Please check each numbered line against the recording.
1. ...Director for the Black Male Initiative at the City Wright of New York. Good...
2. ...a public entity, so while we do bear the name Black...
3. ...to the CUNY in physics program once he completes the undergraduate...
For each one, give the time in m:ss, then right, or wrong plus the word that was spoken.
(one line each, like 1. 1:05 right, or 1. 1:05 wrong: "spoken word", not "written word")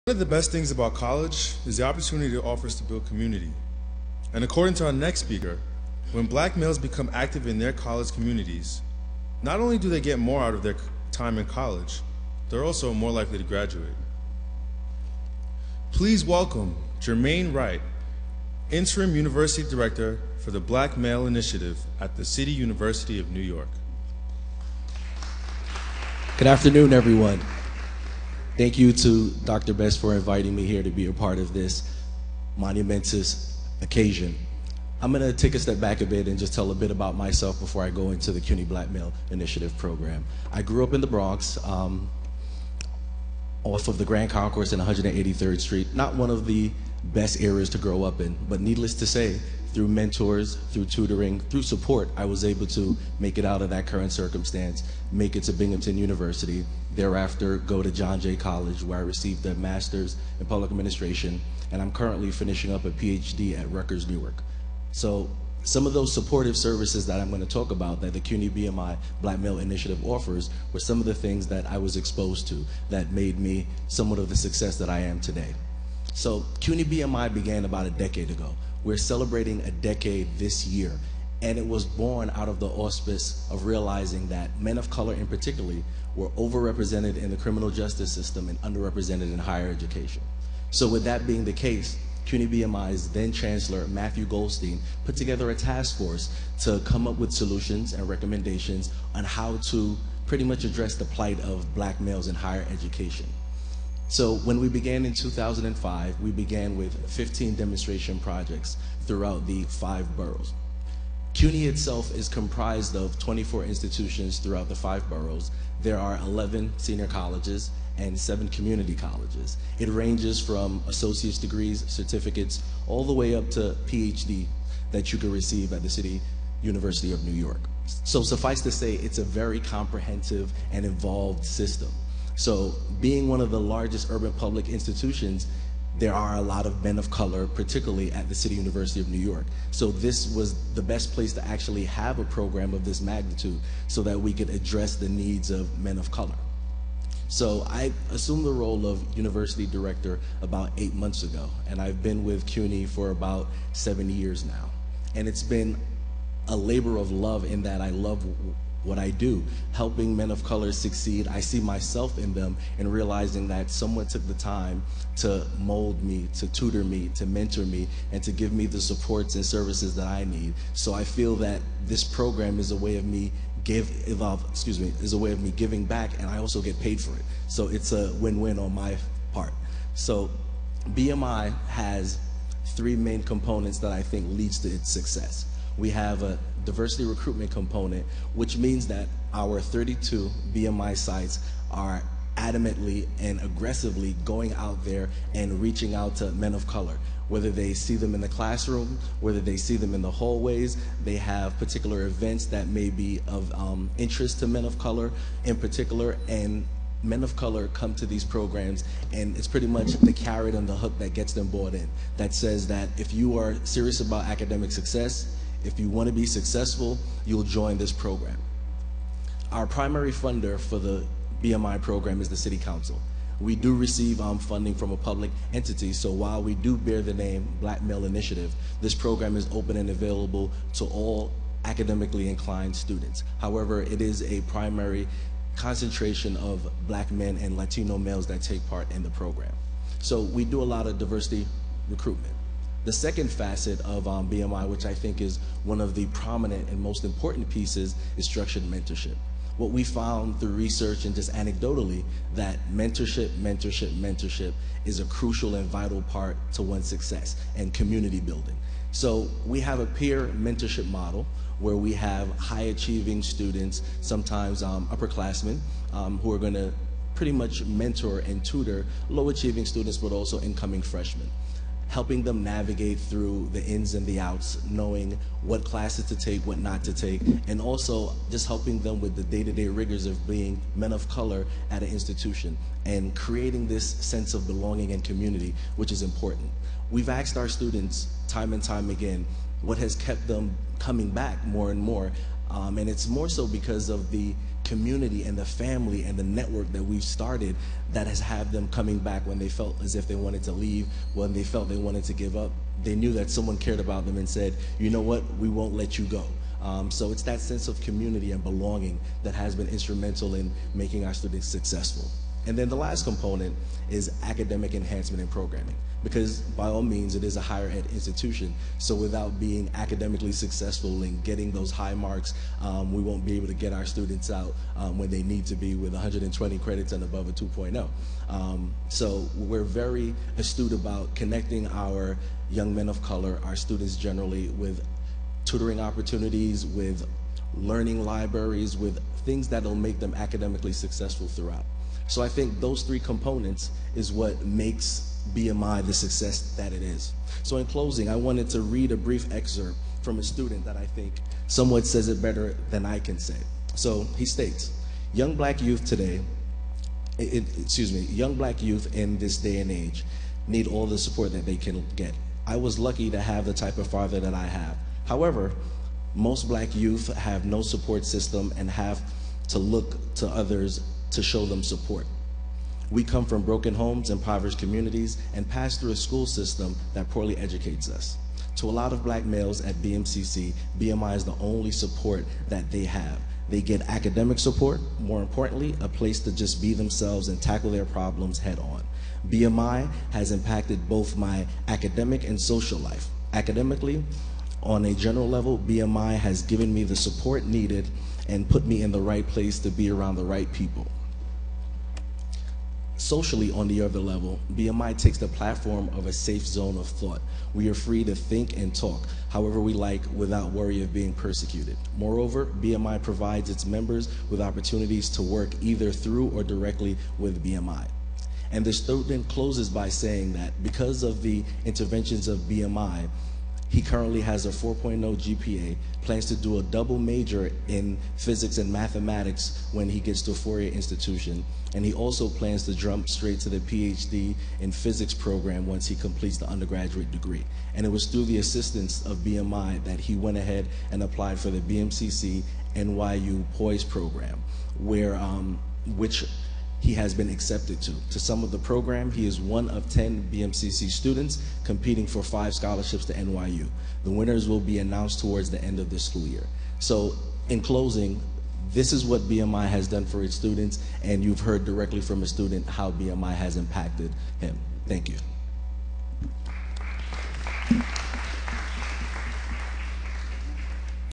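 1. 0:19 wrong: "University", not "Wright"
2. 3:44 right
3. 7:13 wrong: "PhD", not "CUNY".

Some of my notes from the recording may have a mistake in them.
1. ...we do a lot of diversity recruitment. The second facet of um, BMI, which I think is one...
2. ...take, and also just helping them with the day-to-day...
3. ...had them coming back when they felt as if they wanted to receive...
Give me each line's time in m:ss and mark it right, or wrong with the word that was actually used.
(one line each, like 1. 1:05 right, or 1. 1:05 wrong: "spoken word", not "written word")
1. 4:00 right
2. 4:36 right
3. 4:58 wrong: "leave", not "receive".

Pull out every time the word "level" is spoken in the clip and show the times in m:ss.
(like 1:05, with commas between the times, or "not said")
6:35, 6:43.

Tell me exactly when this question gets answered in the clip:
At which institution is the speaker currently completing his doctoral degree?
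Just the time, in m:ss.
1:03.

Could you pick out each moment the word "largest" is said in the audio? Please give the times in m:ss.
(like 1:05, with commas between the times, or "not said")
2:13.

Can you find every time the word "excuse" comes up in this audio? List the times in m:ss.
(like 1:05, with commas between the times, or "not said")
2:54, 5:57.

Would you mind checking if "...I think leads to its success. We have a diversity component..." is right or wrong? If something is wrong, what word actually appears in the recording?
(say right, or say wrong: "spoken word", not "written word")
wrong: "recruitment", not "component".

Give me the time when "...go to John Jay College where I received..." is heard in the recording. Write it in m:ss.
0:57.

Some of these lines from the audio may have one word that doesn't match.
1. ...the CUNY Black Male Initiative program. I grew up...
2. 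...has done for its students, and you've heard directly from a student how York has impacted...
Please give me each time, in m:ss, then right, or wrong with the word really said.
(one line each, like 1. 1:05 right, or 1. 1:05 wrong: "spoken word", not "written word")
1. 0:38 right
2. 7:39 wrong: "BMI", not "York".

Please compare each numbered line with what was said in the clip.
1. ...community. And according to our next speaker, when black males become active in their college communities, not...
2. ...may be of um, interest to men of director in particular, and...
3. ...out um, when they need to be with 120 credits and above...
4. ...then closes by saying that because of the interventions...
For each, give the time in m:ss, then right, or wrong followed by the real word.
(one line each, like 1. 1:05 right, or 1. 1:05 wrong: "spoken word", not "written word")
1. 0:03 right
2. 3:22 wrong: "color", not "director"
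3. 5:24 right
4. 6:59 right.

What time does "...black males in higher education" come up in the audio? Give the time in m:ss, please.
1:41.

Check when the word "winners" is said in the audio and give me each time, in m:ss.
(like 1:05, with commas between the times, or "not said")
7:34.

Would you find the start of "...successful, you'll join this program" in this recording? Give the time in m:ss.
3:36.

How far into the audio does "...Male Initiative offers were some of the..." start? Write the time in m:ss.
1:09.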